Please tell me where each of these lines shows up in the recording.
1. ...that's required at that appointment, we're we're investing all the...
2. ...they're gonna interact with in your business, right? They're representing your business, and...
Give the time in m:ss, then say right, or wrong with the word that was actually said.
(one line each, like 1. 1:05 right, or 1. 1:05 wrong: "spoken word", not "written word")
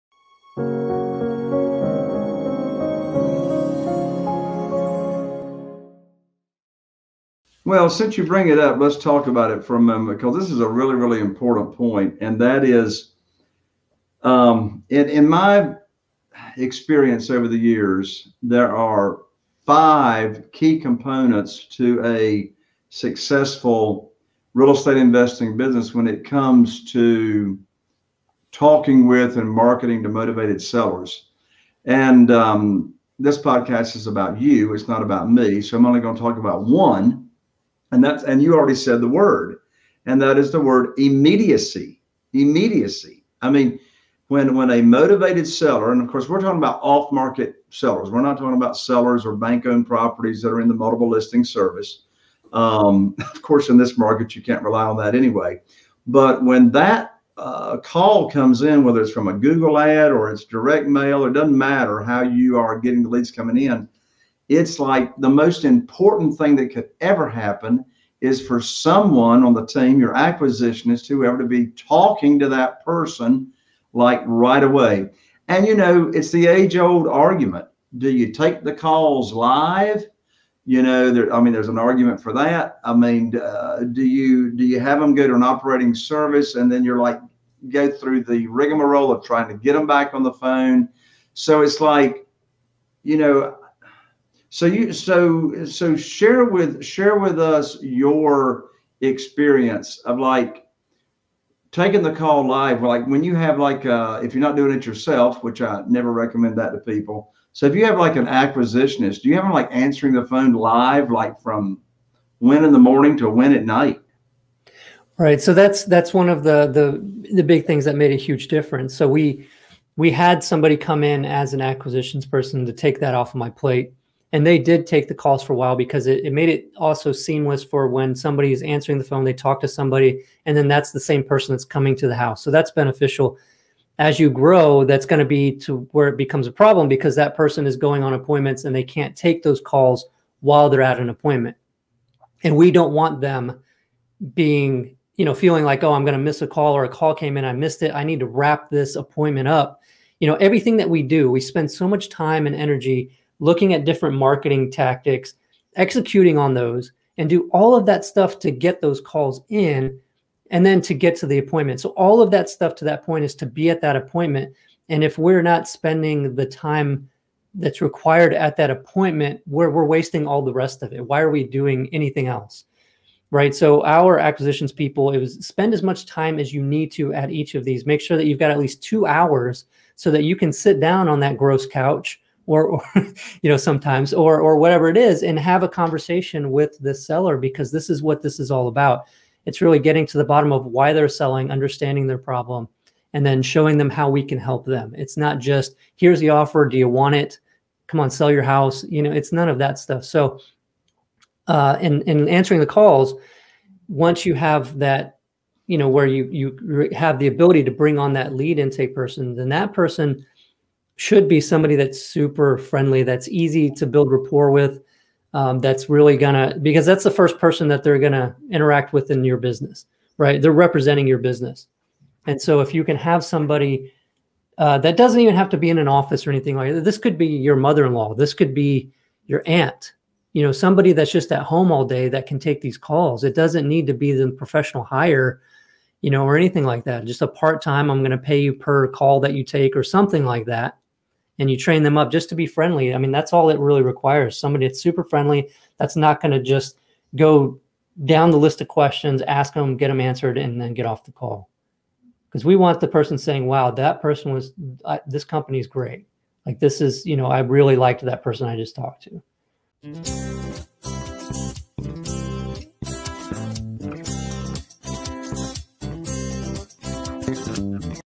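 1. 2:47 wrong: "wasting", not "investing"
2. 3:37 right.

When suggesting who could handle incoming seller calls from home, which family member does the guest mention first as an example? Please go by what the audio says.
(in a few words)
Mother-in-law.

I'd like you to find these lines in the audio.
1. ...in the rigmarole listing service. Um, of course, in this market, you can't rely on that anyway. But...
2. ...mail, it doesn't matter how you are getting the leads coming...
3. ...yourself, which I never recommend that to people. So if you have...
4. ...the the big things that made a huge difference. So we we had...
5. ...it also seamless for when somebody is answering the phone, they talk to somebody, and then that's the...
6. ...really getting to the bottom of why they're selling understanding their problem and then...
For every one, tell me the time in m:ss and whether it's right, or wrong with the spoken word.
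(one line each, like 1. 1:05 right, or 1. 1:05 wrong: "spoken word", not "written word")
1. 0:50 wrong: "multiple", not "rigmarole"
2. 1:00 right
3. 1:44 right
4. 1:56 right
5. 2:06 right
6. 3:09 right.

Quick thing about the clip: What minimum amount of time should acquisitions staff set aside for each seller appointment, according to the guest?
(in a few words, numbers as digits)
2 hours.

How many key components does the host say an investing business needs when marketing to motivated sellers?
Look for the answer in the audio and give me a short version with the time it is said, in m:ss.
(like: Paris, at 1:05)
5, at 0:19.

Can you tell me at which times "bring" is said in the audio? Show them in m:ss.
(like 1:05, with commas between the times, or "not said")
0:08, 3:27.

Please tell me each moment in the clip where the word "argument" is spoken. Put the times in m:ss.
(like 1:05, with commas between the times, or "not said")
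1:17, 1:21.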